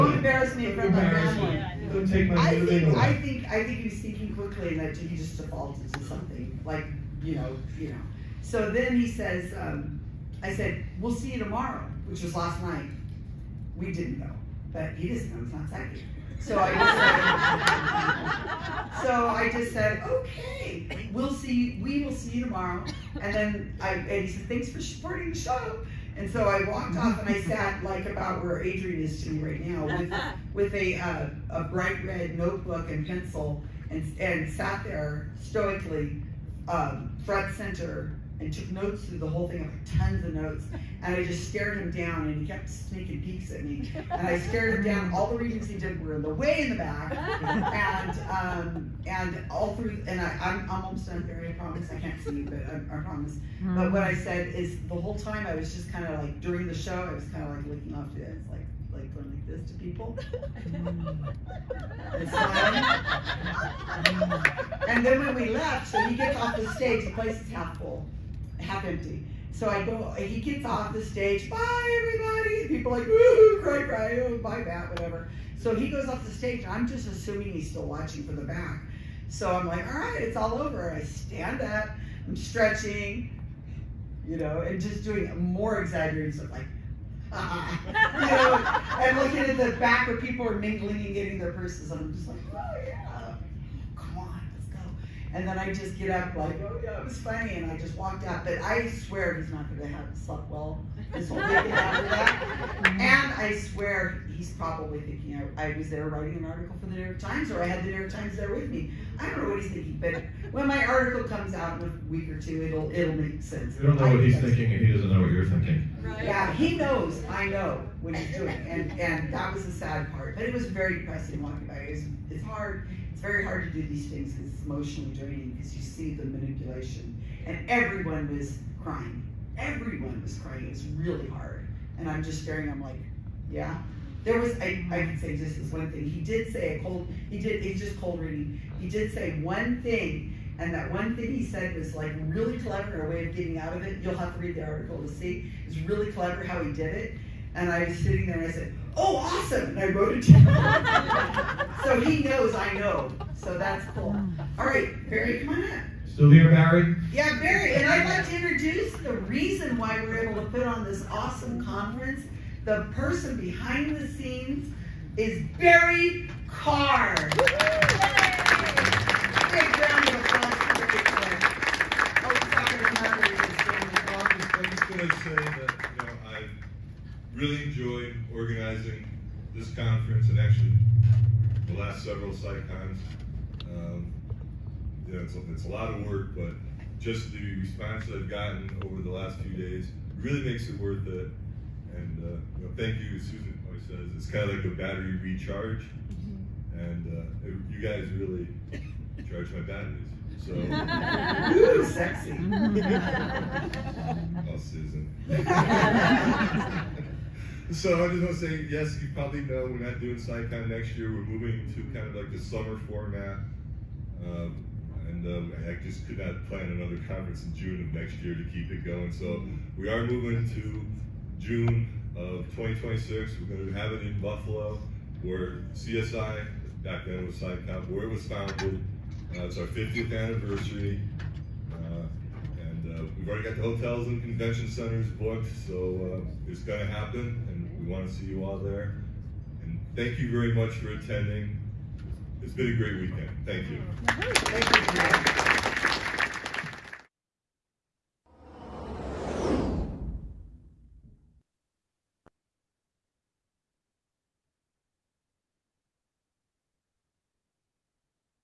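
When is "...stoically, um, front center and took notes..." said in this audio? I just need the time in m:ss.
0:35.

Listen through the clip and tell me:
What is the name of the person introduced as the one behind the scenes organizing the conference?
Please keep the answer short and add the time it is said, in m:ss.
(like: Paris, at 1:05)
Barry Karr, at 2:45.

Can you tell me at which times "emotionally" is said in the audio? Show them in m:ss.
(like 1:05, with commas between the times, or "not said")
2:04.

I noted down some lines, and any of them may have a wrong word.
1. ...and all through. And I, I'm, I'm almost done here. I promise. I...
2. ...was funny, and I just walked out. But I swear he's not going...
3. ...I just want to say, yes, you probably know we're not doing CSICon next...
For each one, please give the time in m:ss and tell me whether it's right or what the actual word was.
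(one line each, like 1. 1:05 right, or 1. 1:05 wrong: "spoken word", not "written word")
1. 0:49 right
2. 1:37 right
3. 3:28 right.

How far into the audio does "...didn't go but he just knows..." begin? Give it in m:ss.
0:13.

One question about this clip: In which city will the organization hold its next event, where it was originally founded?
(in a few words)
Buffalo.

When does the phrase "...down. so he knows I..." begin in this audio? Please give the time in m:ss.
2:30.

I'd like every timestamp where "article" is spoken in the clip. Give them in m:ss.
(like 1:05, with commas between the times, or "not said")
1:46, 1:50, 2:24.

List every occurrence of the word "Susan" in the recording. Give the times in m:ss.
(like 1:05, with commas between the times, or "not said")
3:13, 3:24.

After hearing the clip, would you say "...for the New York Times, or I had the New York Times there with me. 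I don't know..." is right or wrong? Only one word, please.
right.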